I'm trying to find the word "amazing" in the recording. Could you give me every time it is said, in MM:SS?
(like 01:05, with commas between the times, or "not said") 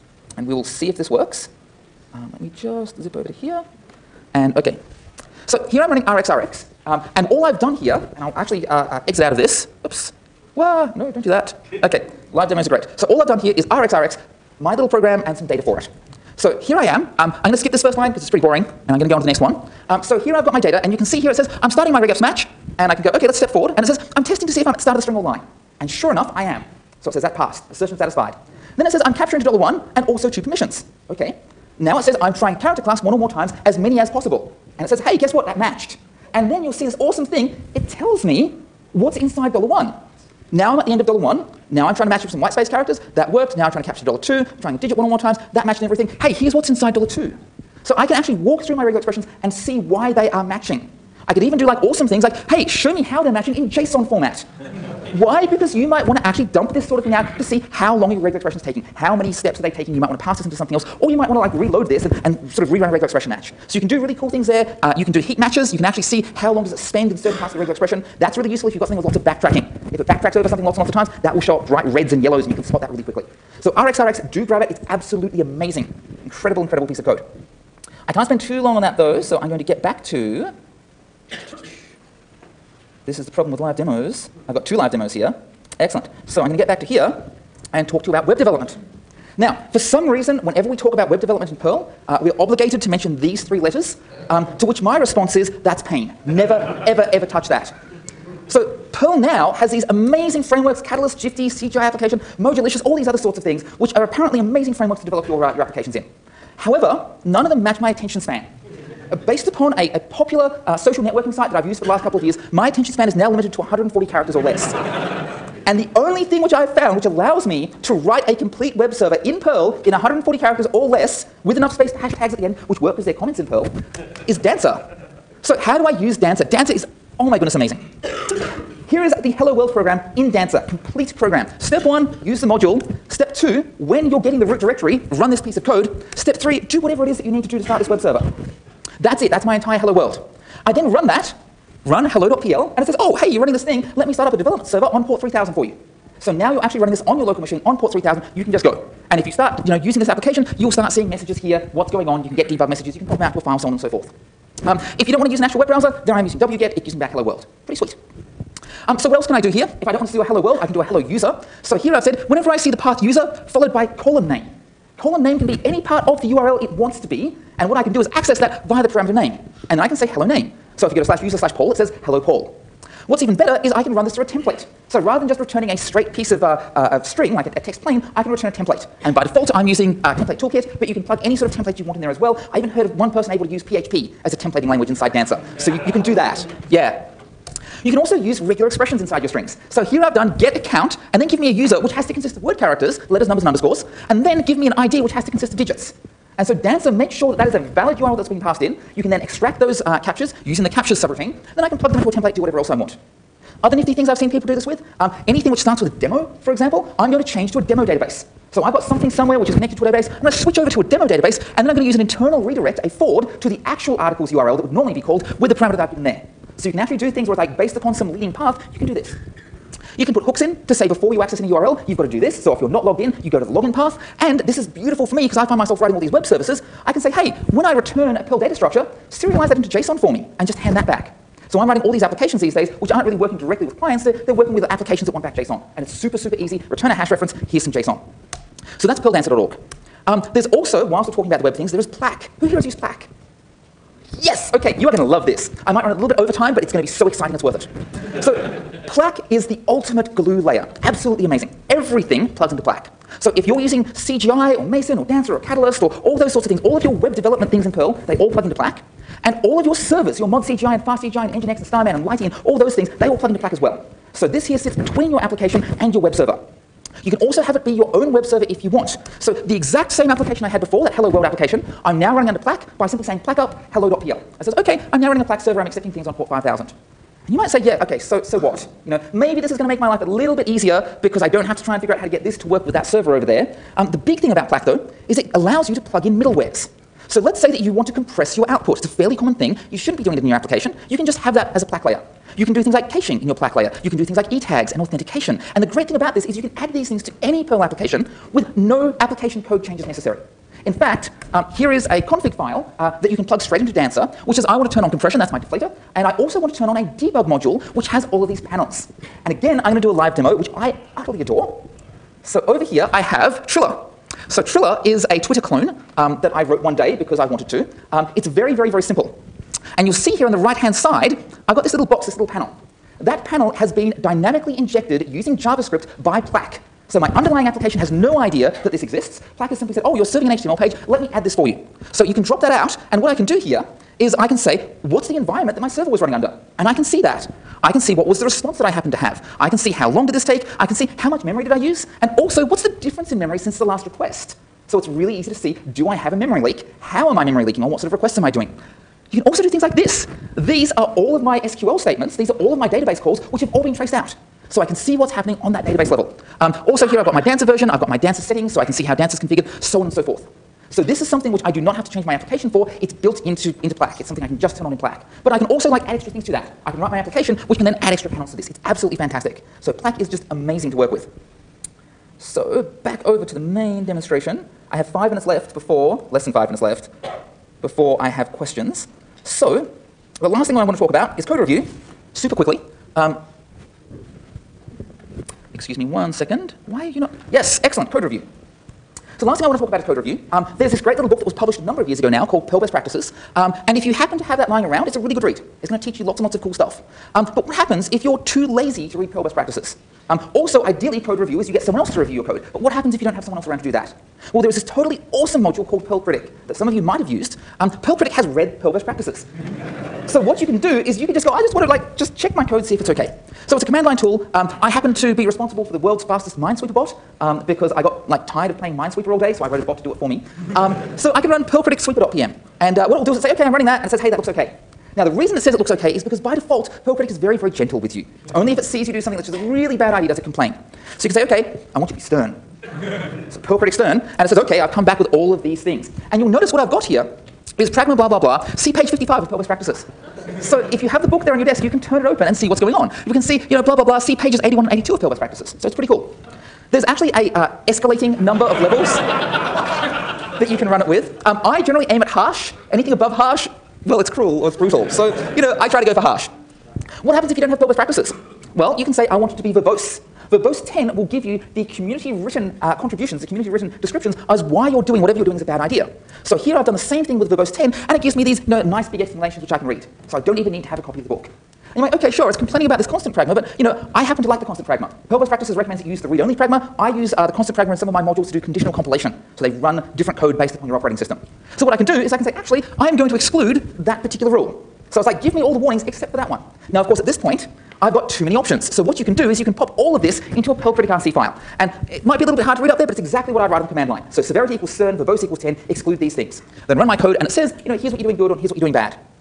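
01:15, 01:39, 01:44, 02:07, 04:11, 06:10.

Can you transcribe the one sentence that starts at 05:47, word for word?
What sort of requests am I doing?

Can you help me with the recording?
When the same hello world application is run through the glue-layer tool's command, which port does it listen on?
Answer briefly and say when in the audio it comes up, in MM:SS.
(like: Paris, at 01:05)
5000, at 04:36.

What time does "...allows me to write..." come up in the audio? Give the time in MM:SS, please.
01:57.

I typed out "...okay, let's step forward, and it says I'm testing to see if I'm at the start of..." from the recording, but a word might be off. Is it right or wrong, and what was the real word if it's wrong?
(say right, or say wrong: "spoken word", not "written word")
right.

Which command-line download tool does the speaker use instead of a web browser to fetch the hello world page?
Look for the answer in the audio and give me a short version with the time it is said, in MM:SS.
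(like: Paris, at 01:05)
wget, at 02:36.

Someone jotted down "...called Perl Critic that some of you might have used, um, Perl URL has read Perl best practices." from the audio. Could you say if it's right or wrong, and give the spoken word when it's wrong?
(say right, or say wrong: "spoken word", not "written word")
wrong: "Critic", not "URL".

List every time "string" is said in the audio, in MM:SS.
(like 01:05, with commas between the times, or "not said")
00:25, 02:57, 03:09.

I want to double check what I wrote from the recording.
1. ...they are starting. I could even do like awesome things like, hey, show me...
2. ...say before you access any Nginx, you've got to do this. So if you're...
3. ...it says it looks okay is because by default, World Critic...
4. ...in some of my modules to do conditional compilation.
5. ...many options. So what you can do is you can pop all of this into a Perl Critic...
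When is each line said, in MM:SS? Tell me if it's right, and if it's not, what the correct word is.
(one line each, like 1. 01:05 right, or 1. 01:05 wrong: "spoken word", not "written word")
1. 00:50 wrong: "matching", not "starting"
2. 03:40 wrong: "URL", not "Nginx"
3. 07:05 wrong: "Perl", not "World"
4. 07:57 right
5. 08:08 right.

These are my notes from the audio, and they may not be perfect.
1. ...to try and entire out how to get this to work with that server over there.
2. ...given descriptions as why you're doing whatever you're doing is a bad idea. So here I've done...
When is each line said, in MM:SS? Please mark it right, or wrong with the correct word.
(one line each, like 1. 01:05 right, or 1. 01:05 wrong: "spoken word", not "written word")
1. 04:41 wrong: "figure", not "entire"
2. 07:43 wrong: "written", not "given".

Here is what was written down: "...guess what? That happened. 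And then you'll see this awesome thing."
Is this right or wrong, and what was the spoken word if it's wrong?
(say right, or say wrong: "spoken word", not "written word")
wrong: "matched", not "happened".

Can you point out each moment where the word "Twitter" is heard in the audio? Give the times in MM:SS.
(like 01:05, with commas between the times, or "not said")
05:15.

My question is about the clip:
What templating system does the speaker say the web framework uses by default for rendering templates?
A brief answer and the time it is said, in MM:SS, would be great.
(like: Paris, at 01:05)
Template Toolkit, at 03:00.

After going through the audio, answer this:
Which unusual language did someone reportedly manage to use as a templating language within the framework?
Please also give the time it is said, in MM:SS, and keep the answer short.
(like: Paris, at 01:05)
PHP, at 03:03.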